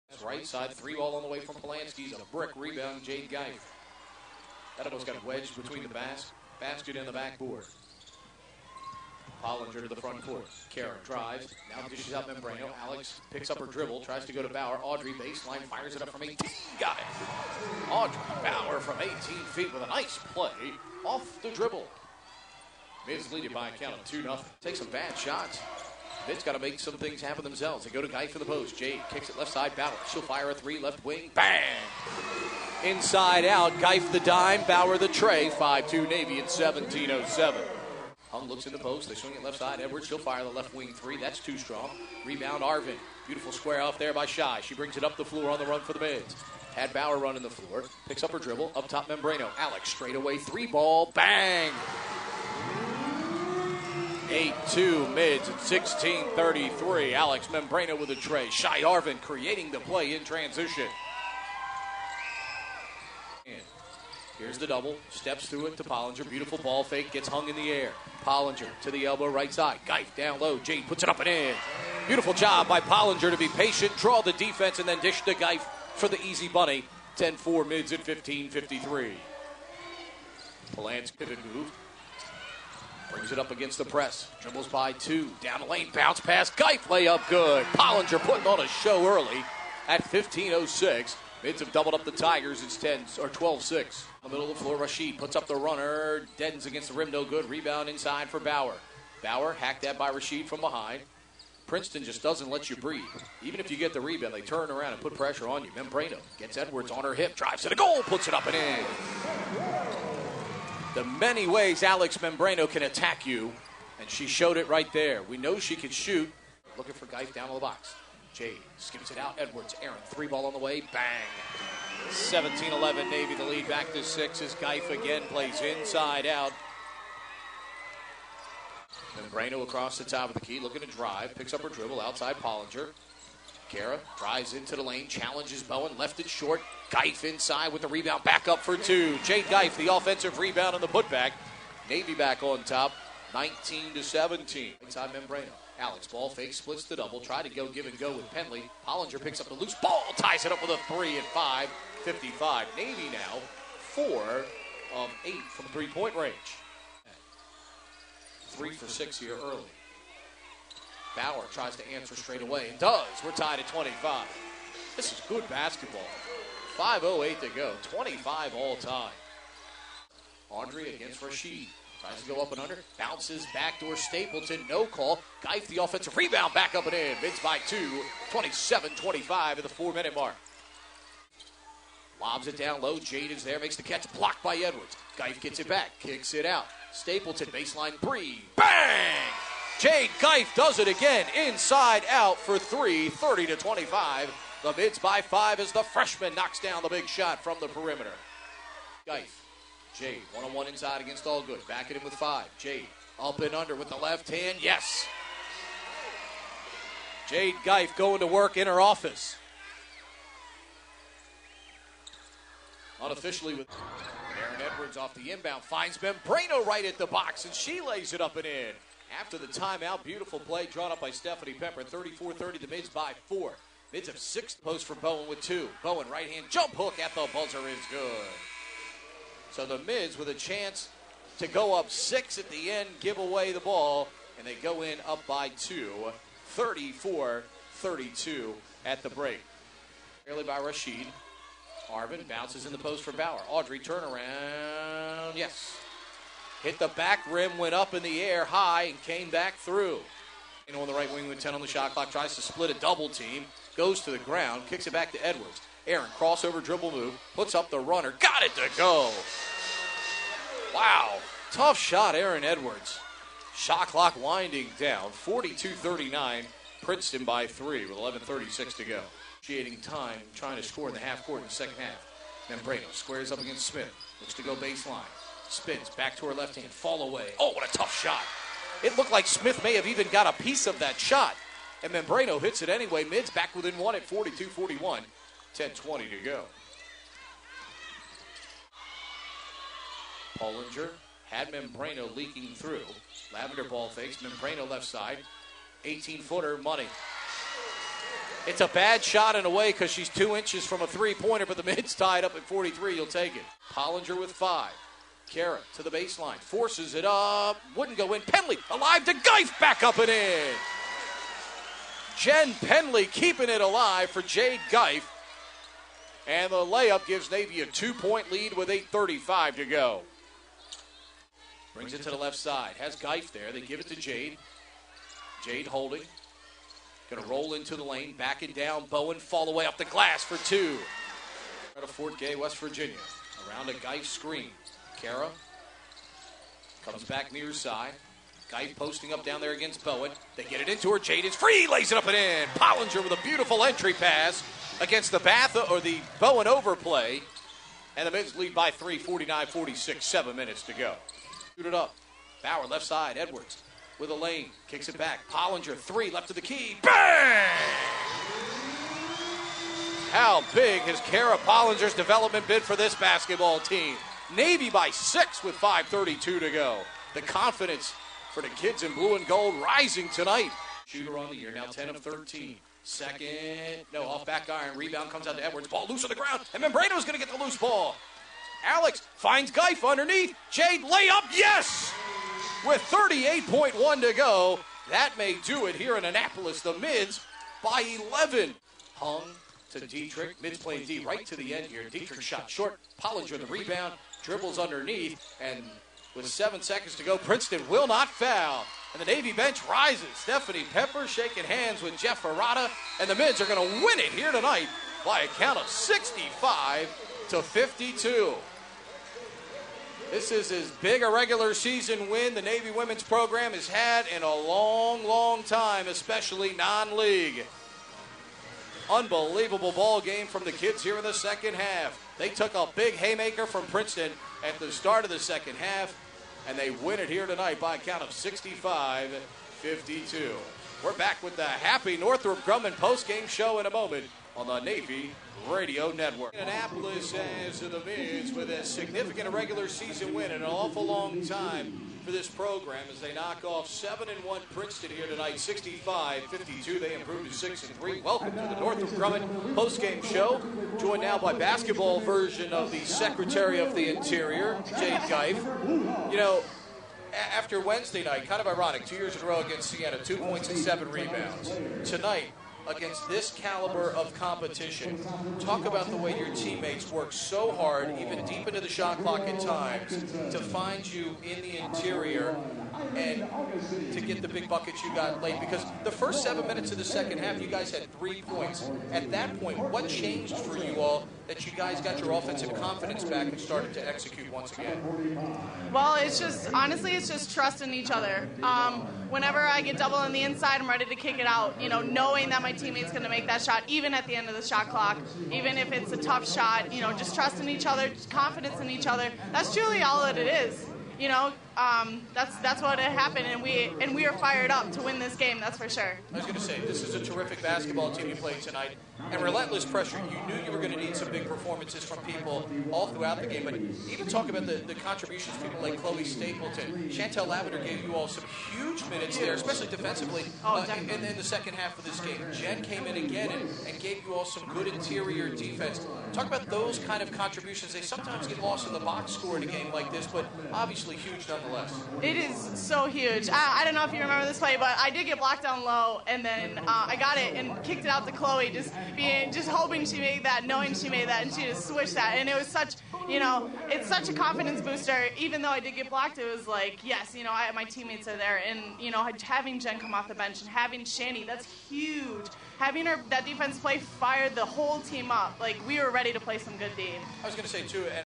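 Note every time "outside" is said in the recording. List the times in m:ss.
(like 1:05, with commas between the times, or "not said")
2:12.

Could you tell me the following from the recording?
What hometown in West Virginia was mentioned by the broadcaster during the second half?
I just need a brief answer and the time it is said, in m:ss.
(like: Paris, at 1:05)
Fort Gay, at 5:31.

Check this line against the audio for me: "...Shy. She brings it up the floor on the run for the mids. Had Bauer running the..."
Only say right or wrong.
right.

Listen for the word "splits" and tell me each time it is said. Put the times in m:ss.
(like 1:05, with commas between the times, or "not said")
2:26, 4:12.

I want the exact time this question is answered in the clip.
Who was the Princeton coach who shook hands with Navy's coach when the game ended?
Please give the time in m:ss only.
6:41.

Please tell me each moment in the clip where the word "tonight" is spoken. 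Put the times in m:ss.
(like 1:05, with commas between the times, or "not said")
6:10, 6:44, 7:07, 7:25, 7:41, 8:28.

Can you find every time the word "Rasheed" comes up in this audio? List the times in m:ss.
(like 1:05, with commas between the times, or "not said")
1:34, 1:40, 2:51, 4:00.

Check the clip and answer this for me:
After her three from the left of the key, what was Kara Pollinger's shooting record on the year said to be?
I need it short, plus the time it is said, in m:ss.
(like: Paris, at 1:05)
10 of 13, at 6:11.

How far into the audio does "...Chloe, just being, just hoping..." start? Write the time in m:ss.
8:58.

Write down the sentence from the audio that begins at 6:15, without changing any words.
Ball loose on the ground, and Membrano's going to get the loose ball.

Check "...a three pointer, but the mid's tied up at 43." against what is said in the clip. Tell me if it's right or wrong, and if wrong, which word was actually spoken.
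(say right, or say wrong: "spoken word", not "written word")
right.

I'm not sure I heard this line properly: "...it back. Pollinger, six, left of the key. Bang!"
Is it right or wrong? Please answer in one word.
wrong.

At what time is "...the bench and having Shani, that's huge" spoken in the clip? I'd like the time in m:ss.
9:10.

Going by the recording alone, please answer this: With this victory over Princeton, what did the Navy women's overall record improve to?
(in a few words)
6-3.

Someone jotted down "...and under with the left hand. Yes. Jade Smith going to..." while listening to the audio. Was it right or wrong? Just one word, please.
wrong.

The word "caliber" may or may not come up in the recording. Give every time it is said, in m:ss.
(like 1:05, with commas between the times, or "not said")
7:43.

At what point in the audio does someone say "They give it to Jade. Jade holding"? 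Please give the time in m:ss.
5:23.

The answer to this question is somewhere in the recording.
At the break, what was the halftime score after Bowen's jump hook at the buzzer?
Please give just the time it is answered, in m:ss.
3:56.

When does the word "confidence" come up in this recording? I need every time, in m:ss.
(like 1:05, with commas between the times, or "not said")
6:07, 8:02, 8:18, 9:04.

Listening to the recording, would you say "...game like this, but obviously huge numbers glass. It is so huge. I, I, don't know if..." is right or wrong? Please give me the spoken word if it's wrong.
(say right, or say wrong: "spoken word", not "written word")
wrong: "nonetheless", not "glass".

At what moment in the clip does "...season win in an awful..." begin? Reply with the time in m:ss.
7:19.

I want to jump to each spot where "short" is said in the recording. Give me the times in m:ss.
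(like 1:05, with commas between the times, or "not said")
2:16, 6:32.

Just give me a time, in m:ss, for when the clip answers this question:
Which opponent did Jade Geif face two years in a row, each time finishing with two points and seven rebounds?
7:39.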